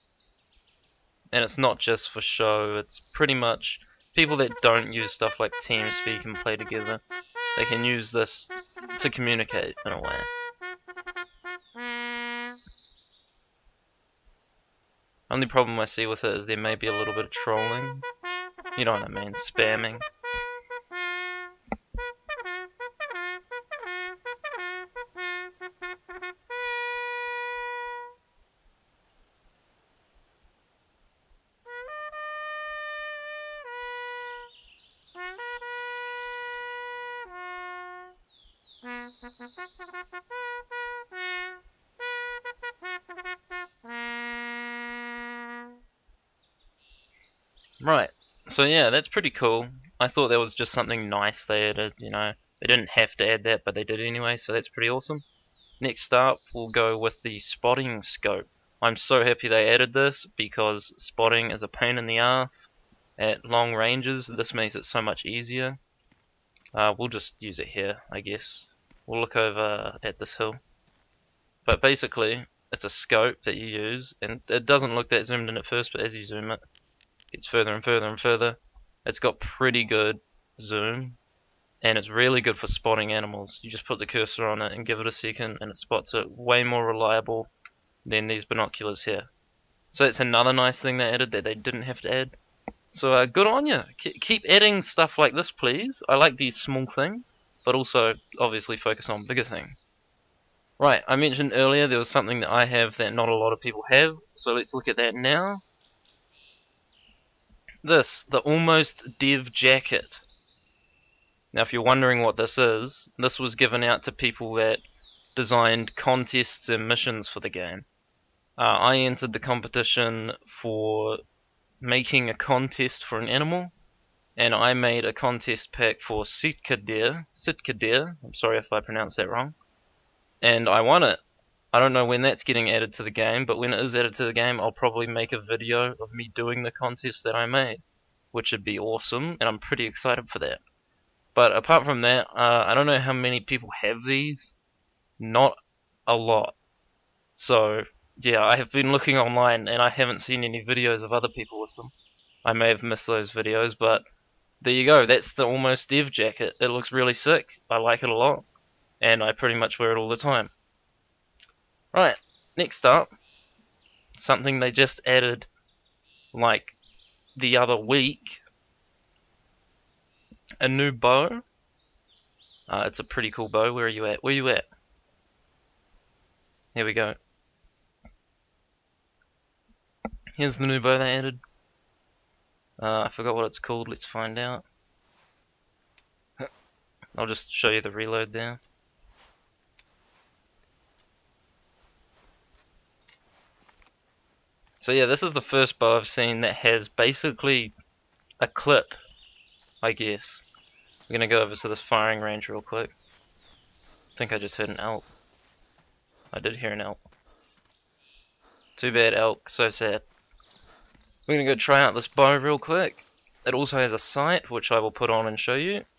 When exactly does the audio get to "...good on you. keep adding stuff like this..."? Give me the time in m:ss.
1:33.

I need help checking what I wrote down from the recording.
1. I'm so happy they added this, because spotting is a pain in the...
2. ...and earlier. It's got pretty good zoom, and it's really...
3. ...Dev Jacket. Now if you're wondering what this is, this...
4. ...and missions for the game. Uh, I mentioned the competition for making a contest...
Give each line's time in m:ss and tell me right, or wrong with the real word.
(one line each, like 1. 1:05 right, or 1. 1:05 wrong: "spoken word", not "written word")
1. 0:58 right
2. 1:18 wrong: "further", not "earlier"
3. 1:49 right
4. 1:56 wrong: "entered", not "mentioned".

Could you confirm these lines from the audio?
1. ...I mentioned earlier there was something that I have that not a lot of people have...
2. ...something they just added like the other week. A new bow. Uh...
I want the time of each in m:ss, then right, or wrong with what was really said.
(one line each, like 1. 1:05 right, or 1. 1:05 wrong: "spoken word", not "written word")
1. 1:41 right
2. 2:44 right.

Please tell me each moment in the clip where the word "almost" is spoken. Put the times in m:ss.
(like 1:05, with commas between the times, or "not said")
1:48, 2:35.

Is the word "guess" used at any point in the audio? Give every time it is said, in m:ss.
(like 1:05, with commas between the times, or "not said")
1:08, 3:19.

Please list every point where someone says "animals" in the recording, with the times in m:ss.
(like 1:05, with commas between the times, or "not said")
1:23, 2:03.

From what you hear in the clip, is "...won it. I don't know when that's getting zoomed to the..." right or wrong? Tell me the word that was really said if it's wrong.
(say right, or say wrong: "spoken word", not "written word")
wrong: "added", not "zoomed".